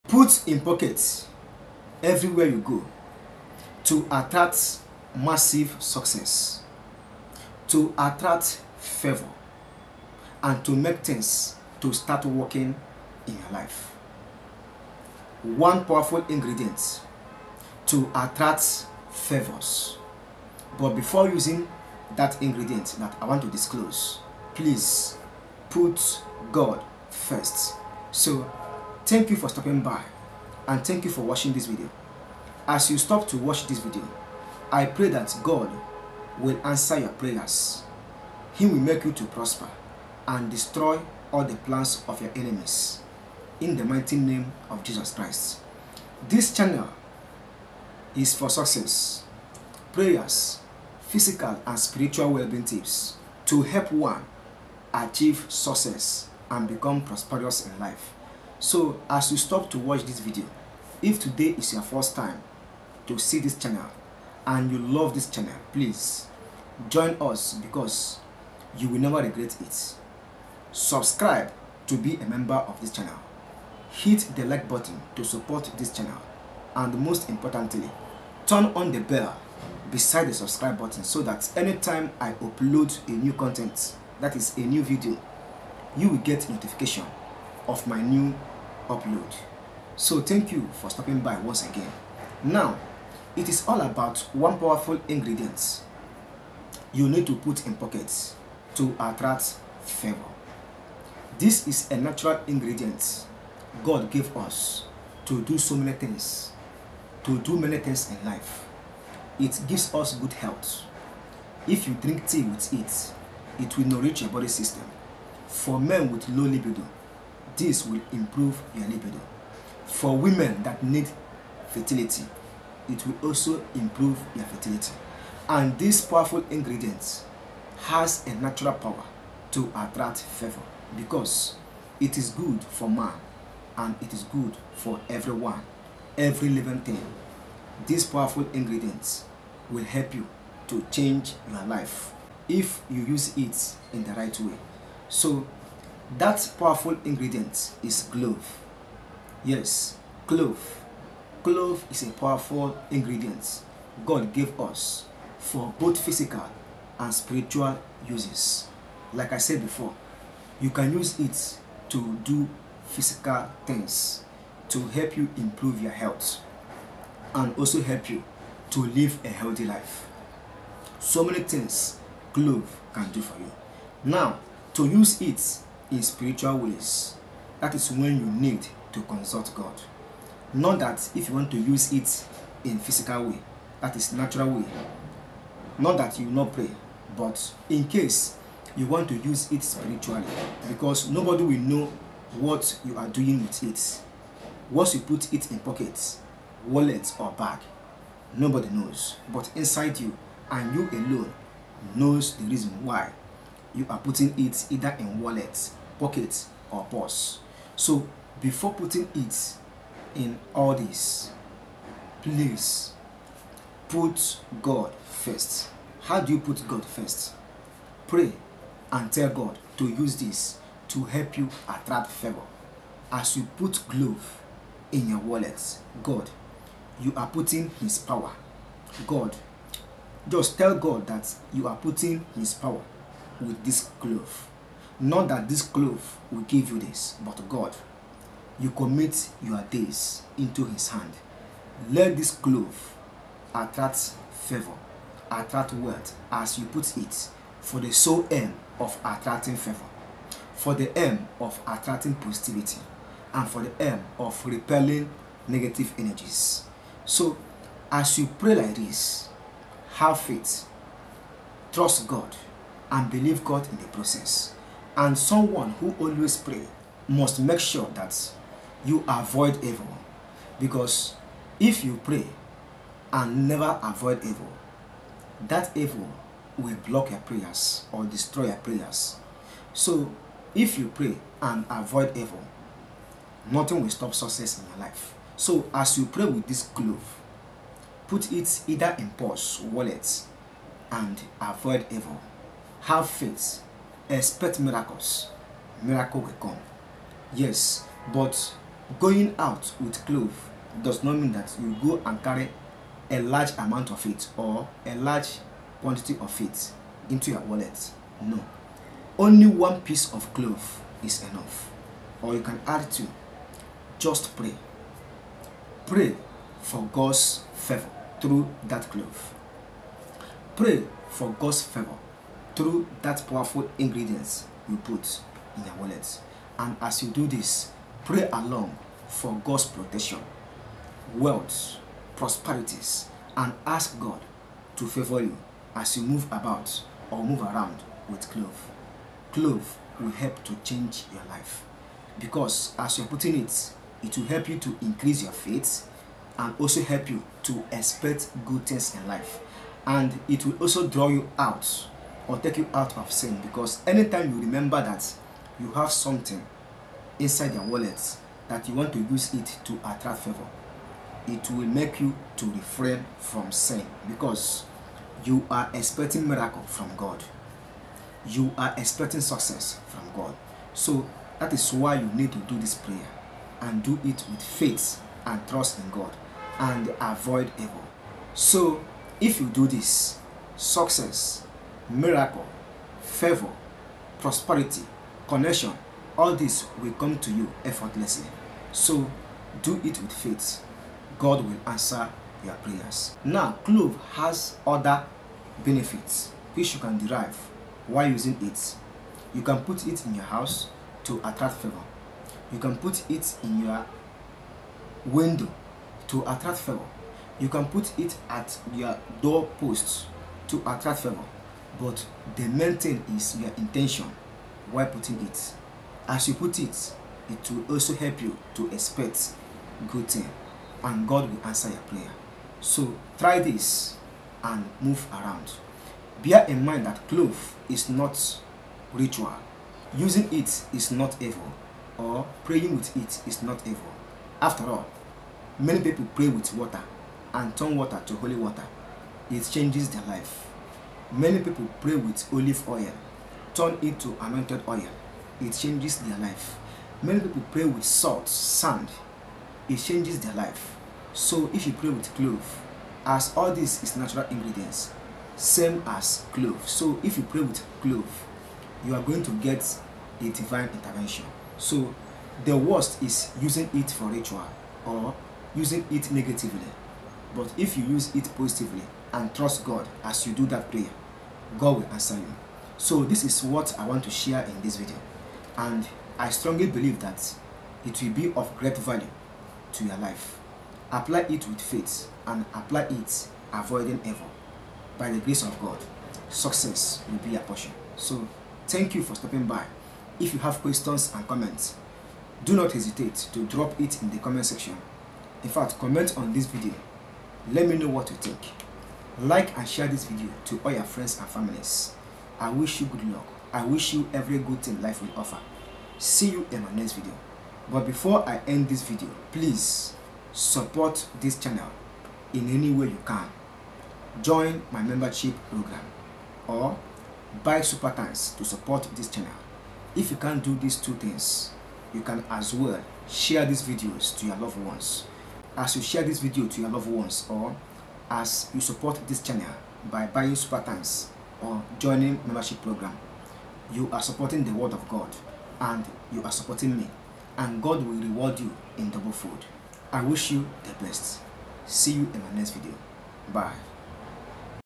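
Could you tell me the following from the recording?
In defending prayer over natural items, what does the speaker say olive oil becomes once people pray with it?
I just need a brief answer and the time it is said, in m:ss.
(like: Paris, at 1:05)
anointed oil, at 7:24.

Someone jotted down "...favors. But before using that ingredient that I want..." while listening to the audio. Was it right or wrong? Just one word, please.
right.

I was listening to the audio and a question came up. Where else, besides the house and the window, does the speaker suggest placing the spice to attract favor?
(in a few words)
doorpost.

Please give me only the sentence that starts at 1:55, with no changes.
For men with low libido, this will improve your libido.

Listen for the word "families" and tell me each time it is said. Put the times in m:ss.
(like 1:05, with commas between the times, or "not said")
8:21.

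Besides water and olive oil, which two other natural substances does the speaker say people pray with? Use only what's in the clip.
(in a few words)
salt, sand.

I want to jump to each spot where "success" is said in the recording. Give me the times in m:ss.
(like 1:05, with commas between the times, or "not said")
0:05, 0:48, 0:55, 4:44, 6:09, 6:20, 8:06.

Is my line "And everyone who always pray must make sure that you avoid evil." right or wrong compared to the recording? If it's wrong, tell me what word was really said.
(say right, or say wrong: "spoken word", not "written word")
wrong: "someone", not "everyone".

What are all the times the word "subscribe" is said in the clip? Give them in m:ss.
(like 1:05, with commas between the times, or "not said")
1:10, 1:20.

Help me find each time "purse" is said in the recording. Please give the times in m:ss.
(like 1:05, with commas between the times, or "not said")
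3:26, 4:49.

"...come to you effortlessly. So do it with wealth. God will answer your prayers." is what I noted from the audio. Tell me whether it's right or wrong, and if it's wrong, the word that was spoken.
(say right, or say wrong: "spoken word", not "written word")
wrong: "faith", not "wealth".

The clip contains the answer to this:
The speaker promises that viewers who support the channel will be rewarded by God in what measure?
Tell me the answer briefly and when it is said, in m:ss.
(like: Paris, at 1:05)
double fold, at 8:58.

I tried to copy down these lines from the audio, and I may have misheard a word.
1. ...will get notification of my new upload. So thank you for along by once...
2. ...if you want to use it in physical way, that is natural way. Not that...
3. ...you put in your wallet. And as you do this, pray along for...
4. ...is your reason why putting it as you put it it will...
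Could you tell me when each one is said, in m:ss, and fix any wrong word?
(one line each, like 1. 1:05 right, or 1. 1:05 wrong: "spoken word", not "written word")
1. 1:26 wrong: "stopping", not "along"
2. 3:01 right
3. 5:24 right
4. 6:53 wrong: "intention", not "reason".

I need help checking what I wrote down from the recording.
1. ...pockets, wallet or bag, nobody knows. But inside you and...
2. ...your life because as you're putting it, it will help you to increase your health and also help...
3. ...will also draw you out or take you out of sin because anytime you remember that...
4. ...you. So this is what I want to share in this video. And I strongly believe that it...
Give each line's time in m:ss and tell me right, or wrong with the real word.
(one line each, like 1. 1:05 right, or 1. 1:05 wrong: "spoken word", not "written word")
1. 3:15 right
2. 5:41 wrong: "faith", not "health"
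3. 5:50 right
4. 7:52 right.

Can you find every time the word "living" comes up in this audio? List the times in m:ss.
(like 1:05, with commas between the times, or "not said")
2:16.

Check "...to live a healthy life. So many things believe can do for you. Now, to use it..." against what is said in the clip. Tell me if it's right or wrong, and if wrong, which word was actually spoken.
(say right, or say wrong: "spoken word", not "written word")
wrong: "clove", not "believe".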